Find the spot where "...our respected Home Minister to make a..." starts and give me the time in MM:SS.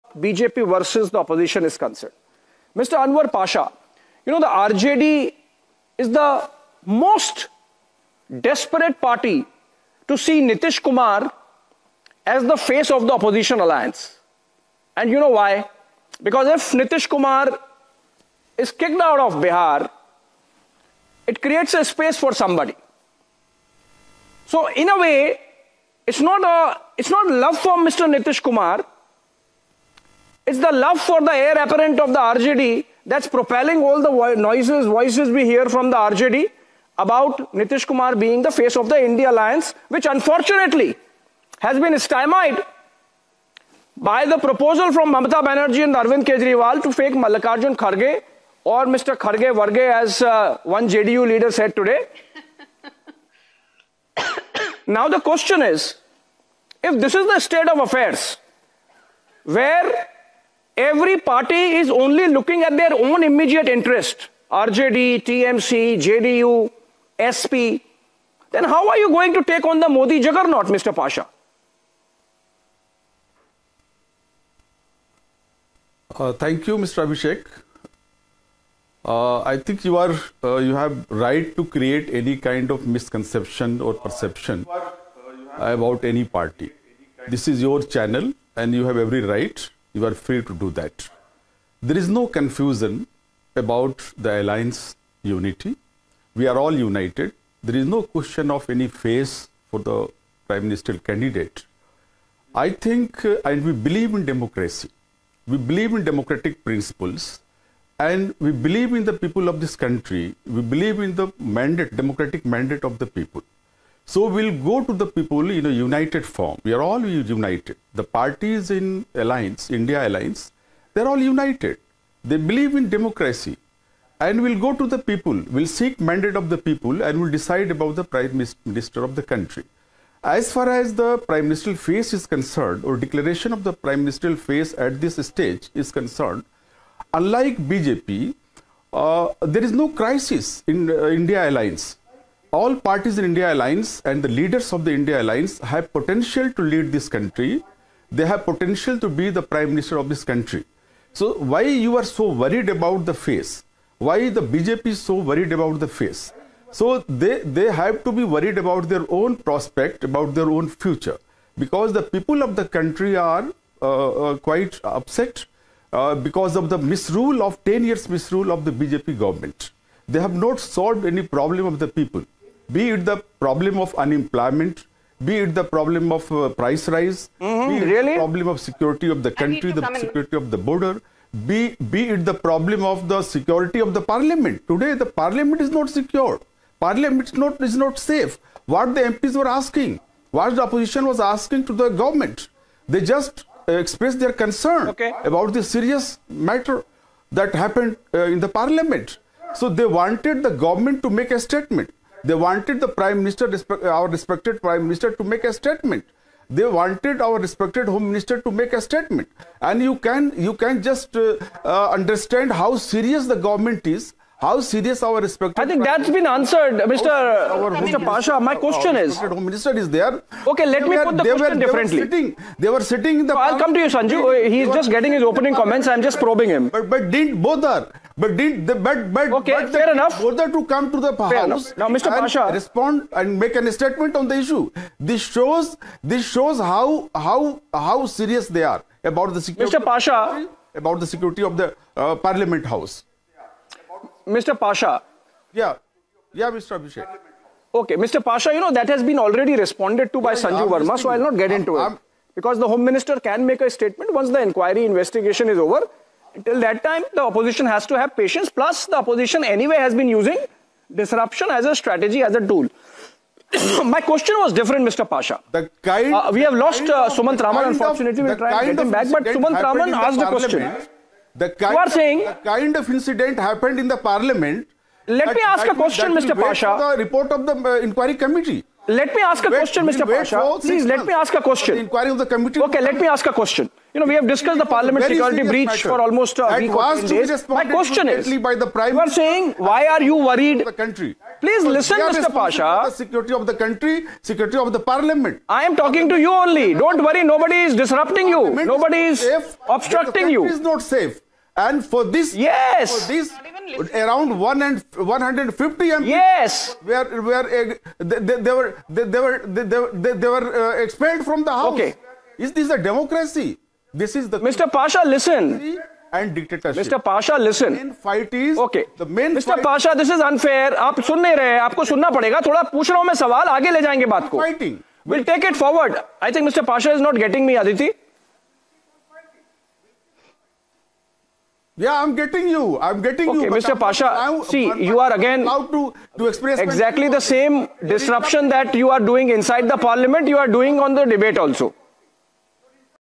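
03:27.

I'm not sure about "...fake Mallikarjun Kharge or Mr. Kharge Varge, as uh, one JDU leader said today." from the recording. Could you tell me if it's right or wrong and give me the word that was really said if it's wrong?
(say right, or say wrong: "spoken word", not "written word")
right.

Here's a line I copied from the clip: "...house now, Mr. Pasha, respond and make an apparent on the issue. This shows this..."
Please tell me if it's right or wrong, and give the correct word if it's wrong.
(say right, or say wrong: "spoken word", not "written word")
wrong: "statement", not "apparent".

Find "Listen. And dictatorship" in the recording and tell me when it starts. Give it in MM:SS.
05:15.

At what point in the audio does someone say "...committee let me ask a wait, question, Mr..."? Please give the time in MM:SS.
04:38.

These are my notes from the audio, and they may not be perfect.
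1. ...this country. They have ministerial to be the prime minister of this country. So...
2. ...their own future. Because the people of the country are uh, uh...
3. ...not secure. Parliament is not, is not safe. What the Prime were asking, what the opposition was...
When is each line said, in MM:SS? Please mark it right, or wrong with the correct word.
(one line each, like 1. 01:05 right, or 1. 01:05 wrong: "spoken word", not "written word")
1. 02:26 wrong: "potential", not "ministerial"
2. 02:40 right
3. 03:05 wrong: "MPs", not "Prime".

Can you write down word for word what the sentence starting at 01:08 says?
Then how are you going to take on the Modi juggernaut, Mr.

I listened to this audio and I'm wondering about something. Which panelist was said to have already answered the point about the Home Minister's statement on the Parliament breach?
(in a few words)
Sanju Verma.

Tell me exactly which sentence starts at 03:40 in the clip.
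Okay, let they me were, put the question were, they Were sitting, they were sitting in the.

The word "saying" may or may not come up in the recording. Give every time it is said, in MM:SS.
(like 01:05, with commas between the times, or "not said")
04:31, 04:49.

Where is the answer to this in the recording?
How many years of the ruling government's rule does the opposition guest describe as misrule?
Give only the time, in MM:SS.
02:47.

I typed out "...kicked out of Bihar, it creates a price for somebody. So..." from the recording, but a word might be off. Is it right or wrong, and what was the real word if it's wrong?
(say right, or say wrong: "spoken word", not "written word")
wrong: "space", not "price".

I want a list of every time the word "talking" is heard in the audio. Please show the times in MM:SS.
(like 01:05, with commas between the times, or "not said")
04:55.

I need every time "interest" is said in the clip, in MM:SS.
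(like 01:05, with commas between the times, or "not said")
01:03.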